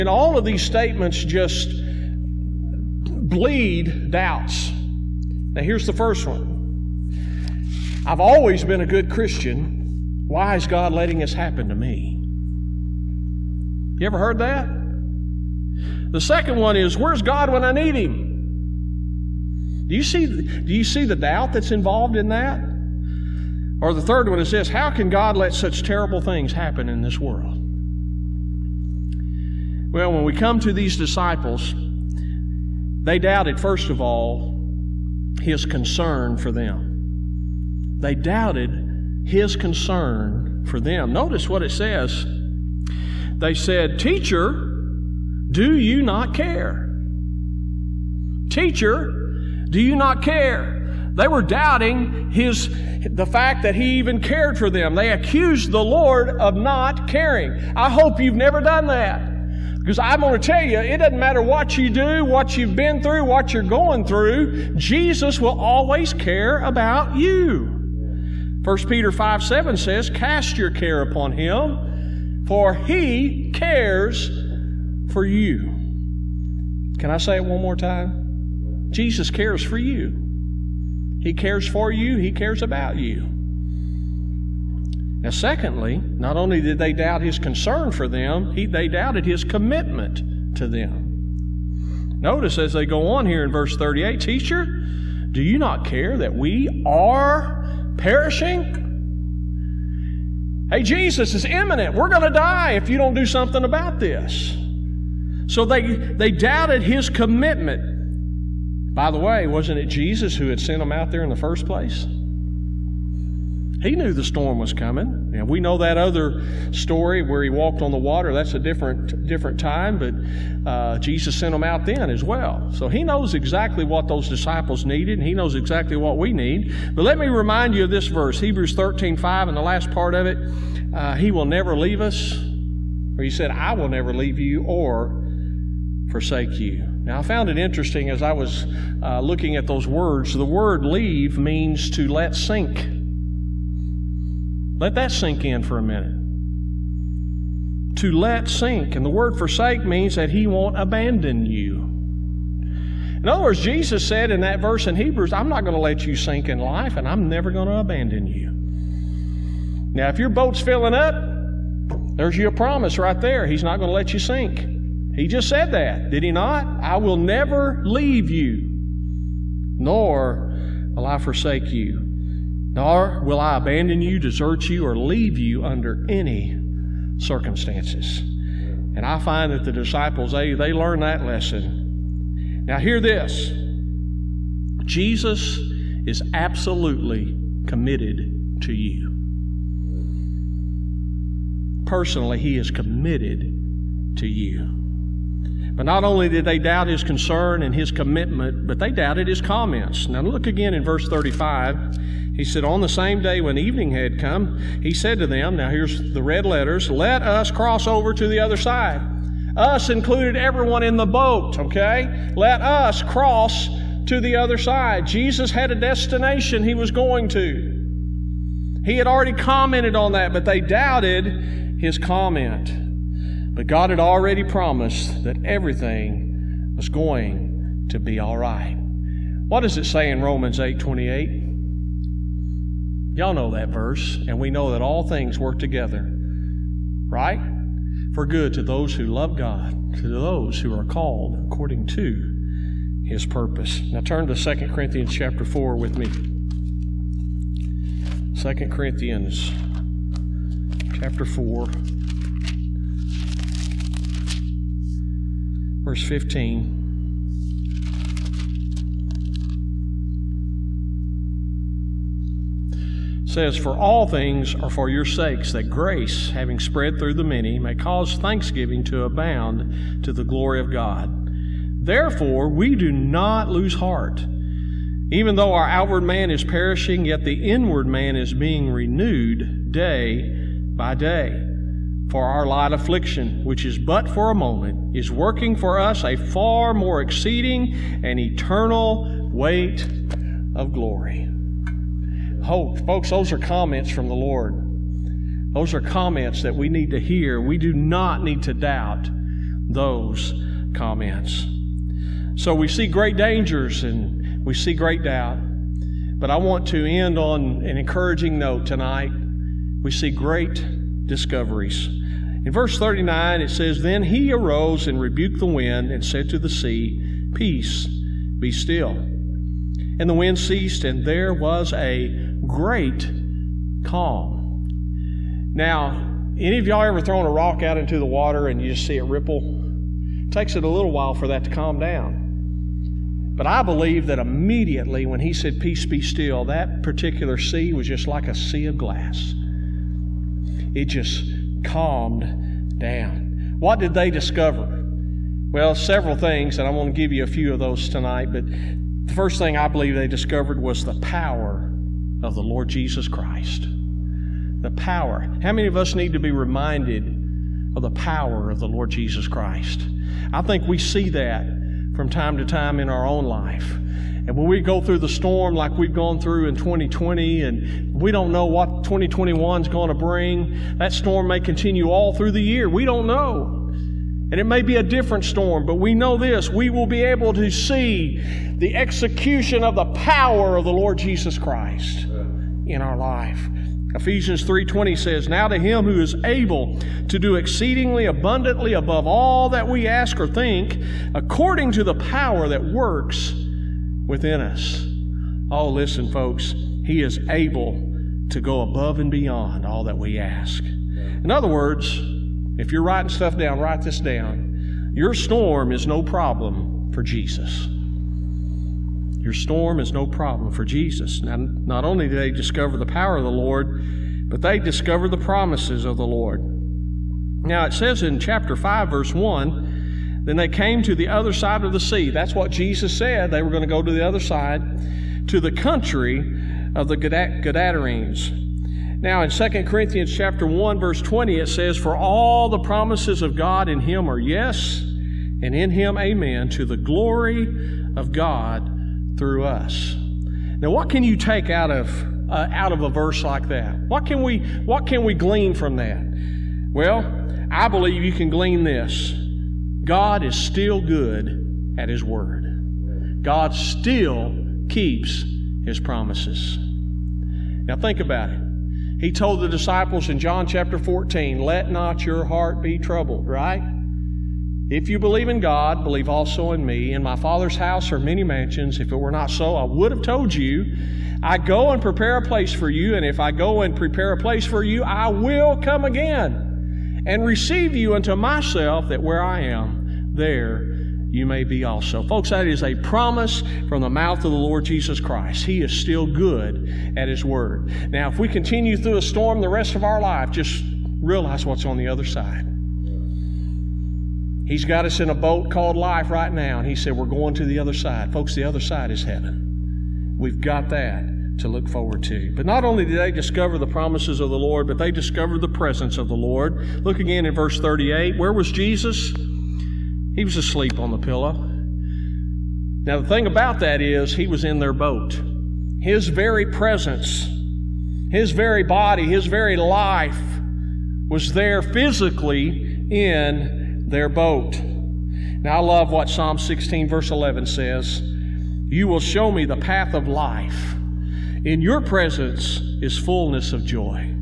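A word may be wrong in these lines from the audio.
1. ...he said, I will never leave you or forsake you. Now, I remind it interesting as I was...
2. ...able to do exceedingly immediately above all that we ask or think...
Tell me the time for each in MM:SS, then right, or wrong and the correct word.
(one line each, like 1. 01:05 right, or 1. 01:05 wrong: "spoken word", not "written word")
1. 02:13 wrong: "found", not "remind"
2. 06:26 wrong: "abundantly", not "immediately".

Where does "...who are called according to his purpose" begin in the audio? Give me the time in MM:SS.
04:00.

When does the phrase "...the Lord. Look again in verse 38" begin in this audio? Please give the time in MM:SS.
08:26.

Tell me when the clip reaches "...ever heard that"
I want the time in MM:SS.
00:14.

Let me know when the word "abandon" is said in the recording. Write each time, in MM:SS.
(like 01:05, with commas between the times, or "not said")
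02:30, 02:37, 02:53.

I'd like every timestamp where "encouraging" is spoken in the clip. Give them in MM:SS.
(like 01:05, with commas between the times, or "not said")
05:07.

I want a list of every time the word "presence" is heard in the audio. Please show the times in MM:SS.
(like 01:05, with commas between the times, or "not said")
08:25, 08:36, 08:51.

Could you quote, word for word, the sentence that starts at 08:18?
Folks, the other side is heaven.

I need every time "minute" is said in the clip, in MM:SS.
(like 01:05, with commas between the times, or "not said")
02:25.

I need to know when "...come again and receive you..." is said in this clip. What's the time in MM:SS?
07:55.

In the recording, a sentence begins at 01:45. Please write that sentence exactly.
So they, they doubted his commitment.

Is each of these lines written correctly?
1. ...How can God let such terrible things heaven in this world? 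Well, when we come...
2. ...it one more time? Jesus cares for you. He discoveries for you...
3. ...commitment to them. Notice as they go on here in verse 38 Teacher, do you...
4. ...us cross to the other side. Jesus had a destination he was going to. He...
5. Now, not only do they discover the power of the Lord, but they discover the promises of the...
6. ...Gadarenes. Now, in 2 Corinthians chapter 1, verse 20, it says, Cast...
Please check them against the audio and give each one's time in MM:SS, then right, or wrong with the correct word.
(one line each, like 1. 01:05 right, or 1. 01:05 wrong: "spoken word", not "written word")
1. 00:24 wrong: "happen", not "heaven"
2. 01:17 wrong: "cares", not "discoveries"
3. 01:29 right
4. 03:32 right
5. 06:51 right
6. 07:06 wrong: "For", not "Cast".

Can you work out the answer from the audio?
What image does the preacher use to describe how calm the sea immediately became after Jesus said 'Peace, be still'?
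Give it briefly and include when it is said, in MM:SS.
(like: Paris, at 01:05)
a sea of glass, at 05:38.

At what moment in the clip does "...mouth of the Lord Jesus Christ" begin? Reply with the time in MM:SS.
08:03.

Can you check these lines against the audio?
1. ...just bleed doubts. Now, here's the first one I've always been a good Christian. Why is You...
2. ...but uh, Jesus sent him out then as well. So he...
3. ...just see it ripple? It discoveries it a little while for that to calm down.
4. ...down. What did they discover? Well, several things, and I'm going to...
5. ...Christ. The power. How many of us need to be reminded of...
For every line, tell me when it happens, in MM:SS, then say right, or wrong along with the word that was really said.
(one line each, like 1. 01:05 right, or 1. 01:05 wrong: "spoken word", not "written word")
1. 00:01 wrong: "God", not "You"
2. 02:00 right
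3. 05:28 wrong: "takes", not "discoveries"
4. 05:42 right
5. 05:53 right.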